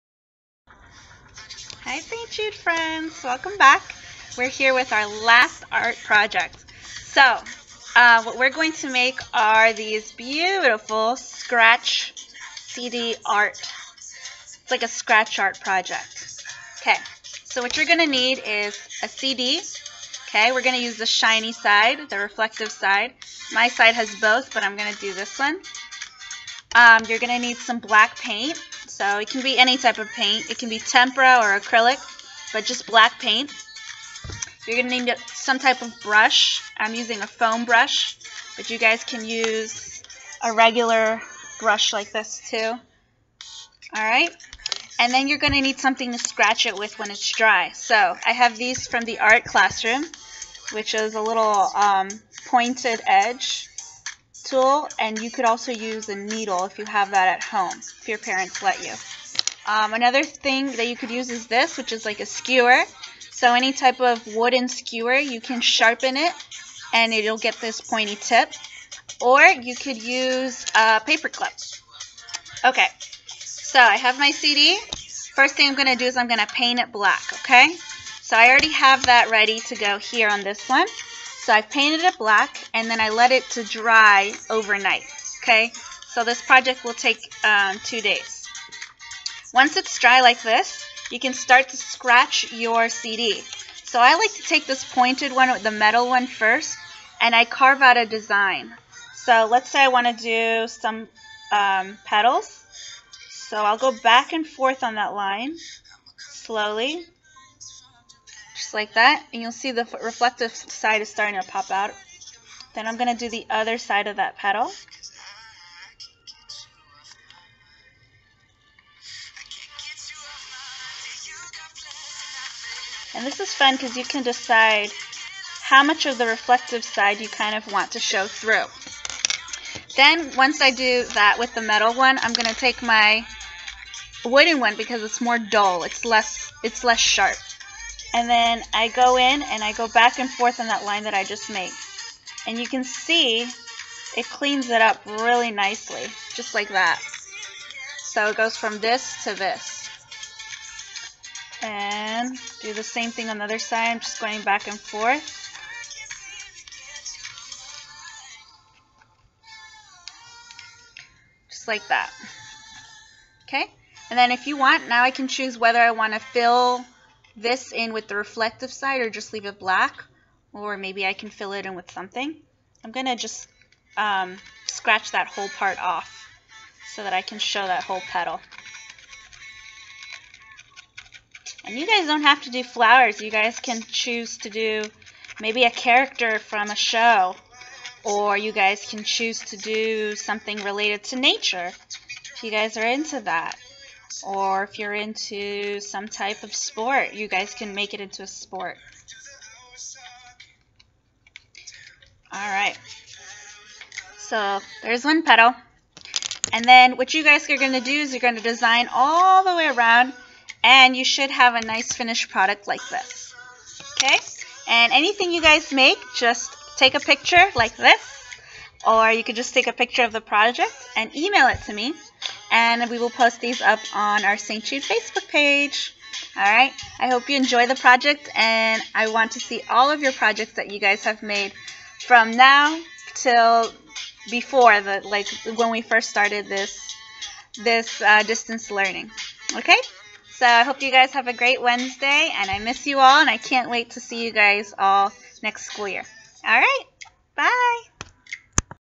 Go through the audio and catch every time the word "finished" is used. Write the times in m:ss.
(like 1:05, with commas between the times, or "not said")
3:31.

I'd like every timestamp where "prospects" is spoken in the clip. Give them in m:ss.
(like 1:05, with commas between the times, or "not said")
not said.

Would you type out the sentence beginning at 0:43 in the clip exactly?
Alright, and then you're going to need something to scratch it with when it's dry.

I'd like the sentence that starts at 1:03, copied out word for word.
So any type of wooden skewer, you can sharpen it, and it'll get this pointy tip.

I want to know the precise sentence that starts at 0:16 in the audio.
Okay, so what you're going to need is a CD.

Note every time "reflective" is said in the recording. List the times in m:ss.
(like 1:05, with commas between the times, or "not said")
0:22, 1:50, 2:06, 2:48.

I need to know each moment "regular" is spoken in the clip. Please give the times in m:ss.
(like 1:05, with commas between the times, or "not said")
0:40.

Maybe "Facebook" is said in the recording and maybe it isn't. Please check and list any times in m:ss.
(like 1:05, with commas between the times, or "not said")
3:44.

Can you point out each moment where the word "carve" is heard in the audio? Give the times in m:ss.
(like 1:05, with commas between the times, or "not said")
1:37.